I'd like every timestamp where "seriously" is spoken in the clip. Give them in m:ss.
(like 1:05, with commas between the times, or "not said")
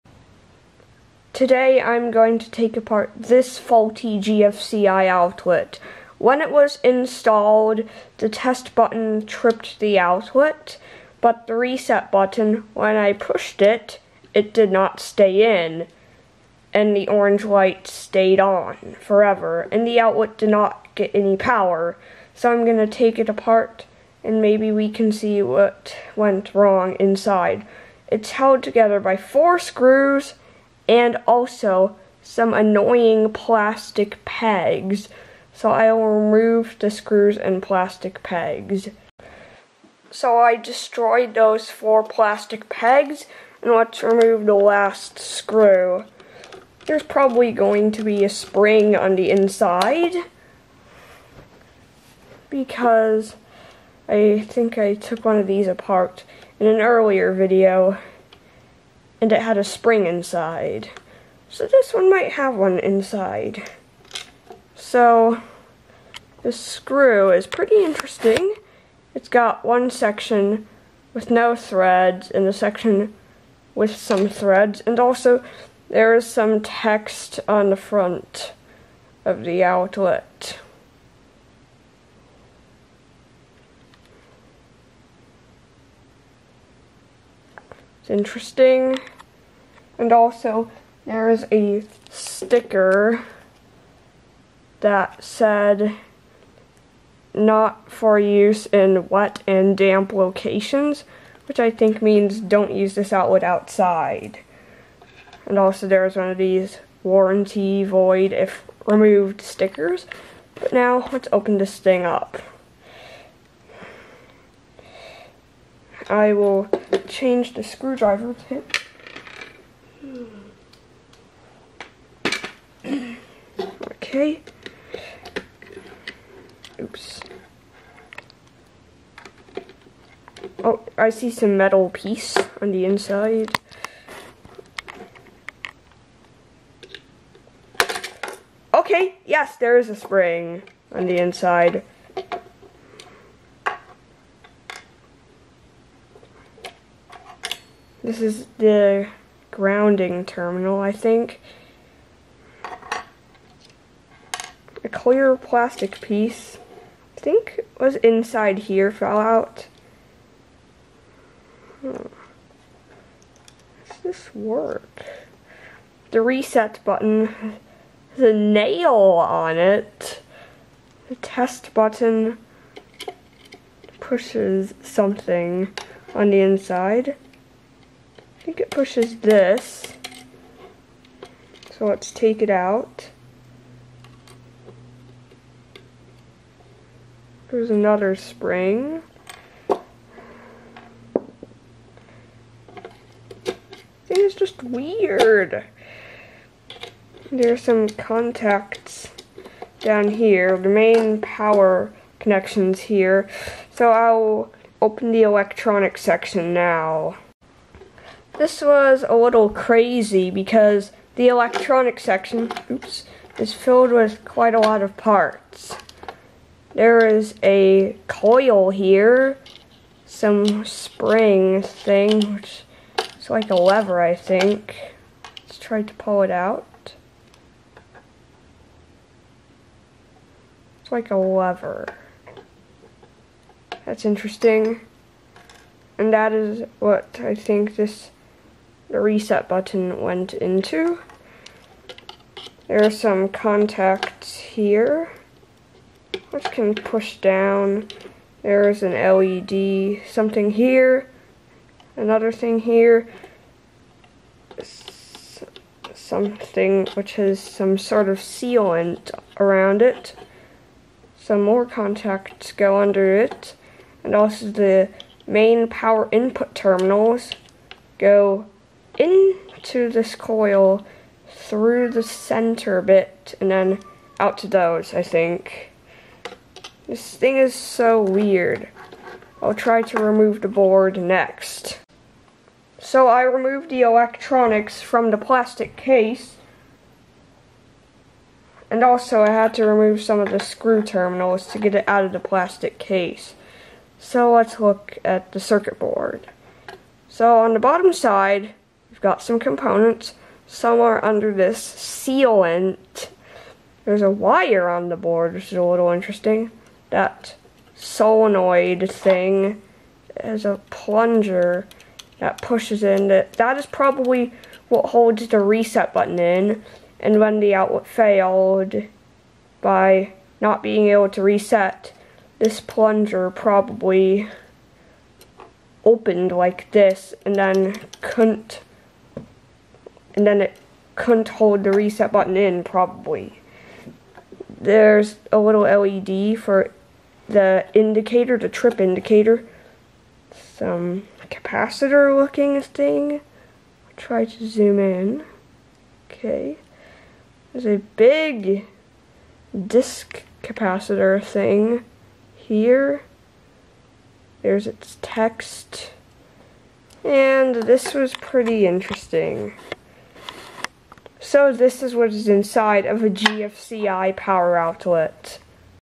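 not said.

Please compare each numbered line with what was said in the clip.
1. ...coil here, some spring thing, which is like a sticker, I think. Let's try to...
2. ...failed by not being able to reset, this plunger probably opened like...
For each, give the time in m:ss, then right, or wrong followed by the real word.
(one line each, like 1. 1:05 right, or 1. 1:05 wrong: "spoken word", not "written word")
1. 3:38 wrong: "lever", not "sticker"
2. 5:17 right.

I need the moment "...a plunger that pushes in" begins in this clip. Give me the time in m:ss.
5:10.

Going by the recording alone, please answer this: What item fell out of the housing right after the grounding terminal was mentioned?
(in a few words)
clear plastic piece.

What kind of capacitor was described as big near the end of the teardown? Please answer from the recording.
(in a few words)
disk capacitor.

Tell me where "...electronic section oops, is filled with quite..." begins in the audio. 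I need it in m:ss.
3:31.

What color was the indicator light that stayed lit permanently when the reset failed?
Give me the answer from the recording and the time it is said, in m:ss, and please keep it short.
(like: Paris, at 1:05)
orange, at 0:17.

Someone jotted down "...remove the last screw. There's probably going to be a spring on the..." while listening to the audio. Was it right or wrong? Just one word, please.
right.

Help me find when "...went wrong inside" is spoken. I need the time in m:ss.
0:26.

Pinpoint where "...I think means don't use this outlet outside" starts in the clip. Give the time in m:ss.
1:41.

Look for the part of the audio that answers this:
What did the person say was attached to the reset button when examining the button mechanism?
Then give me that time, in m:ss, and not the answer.
2:48.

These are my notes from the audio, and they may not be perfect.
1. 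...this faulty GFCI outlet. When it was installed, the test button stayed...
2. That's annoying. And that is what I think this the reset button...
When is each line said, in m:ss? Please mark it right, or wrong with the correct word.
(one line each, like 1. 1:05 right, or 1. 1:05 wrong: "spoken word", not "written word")
1. 0:03 wrong: "tripped", not "stayed"
2. 3:53 wrong: "interesting", not "annoying".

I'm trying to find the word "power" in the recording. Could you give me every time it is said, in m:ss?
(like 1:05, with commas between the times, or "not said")
0:21, 3:21, 4:25, 6:04.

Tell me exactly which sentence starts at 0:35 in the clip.
So I will remove the screws and plastic pegs.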